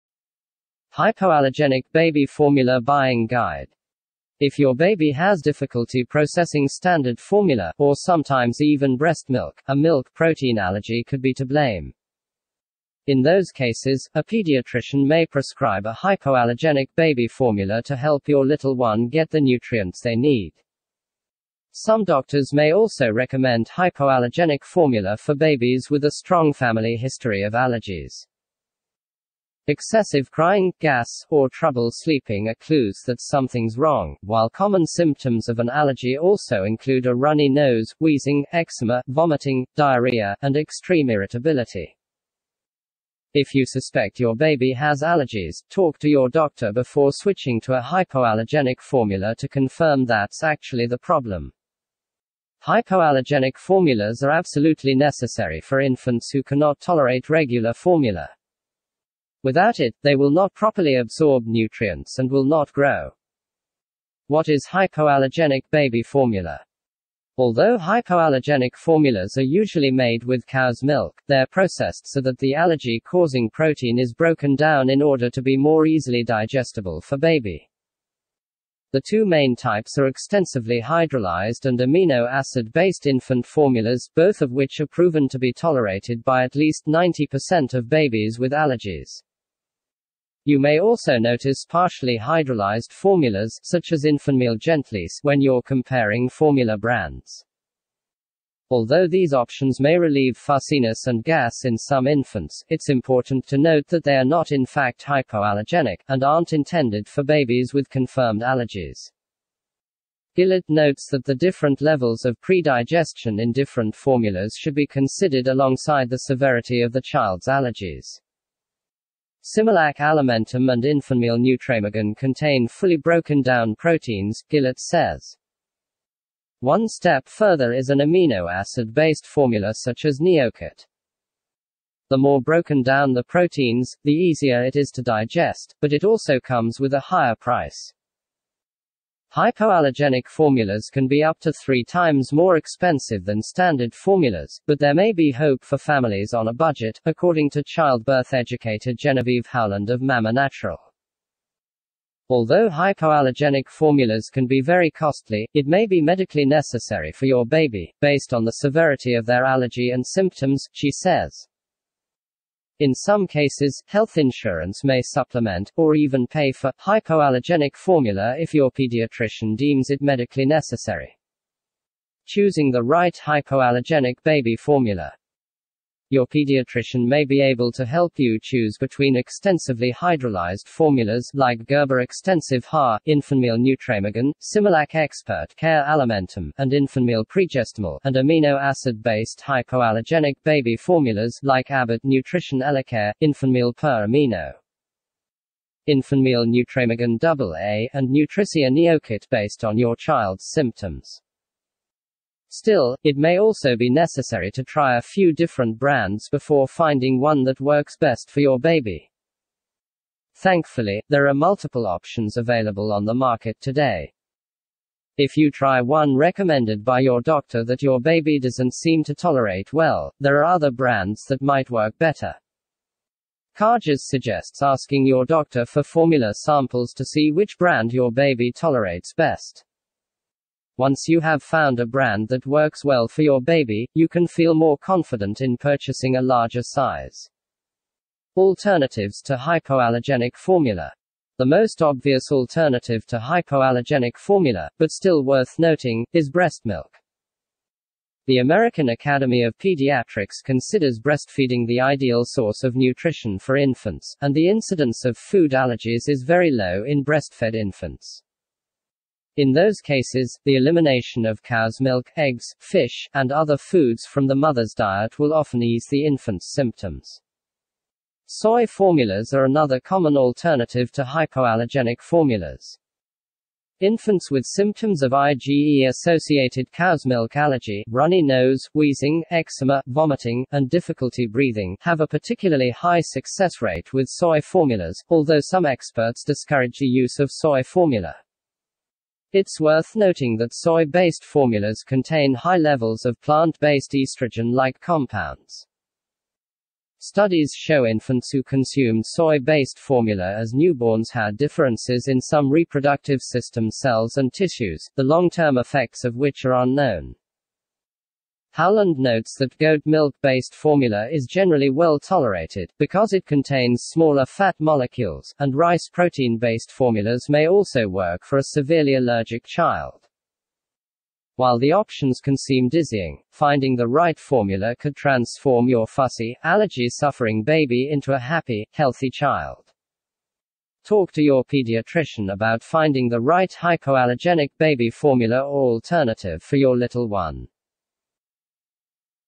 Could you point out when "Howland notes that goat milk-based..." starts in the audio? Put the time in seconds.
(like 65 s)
308 s.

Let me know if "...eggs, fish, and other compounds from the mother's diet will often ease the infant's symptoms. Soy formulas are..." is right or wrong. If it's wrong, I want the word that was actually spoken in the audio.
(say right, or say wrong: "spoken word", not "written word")
wrong: "foods", not "compounds".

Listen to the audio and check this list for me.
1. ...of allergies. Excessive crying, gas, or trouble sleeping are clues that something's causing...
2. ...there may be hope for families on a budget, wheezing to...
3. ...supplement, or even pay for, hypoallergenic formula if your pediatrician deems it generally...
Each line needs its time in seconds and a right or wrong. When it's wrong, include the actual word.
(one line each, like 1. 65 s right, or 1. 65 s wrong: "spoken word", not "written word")
1. 27 s wrong: "wrong", not "causing"
2. 144 s wrong: "according", not "wheezing"
3. 165 s wrong: "medically", not "generally".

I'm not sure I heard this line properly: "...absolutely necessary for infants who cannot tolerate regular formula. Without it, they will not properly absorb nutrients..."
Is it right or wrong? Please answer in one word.
right.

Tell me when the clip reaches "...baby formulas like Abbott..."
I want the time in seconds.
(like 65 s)
190 s.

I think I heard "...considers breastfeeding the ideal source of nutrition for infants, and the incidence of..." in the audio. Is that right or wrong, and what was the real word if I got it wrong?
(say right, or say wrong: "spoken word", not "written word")
right.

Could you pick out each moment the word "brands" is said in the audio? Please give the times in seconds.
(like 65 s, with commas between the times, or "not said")
96 s, 205 s, 220 s, 227 s, 231 s.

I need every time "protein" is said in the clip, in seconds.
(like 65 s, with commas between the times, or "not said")
10 s, 73 s, 123 s, 133 s, 315 s.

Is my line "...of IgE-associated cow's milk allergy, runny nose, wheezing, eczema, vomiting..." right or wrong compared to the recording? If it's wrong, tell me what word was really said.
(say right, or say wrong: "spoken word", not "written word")
right.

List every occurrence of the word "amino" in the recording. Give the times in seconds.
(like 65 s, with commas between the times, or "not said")
81 s, 127 s, 188 s, 194 s.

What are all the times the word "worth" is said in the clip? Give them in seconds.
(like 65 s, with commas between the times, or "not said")
245 s, 289 s.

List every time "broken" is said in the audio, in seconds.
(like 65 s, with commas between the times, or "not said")
74 s, 122 s, 132 s.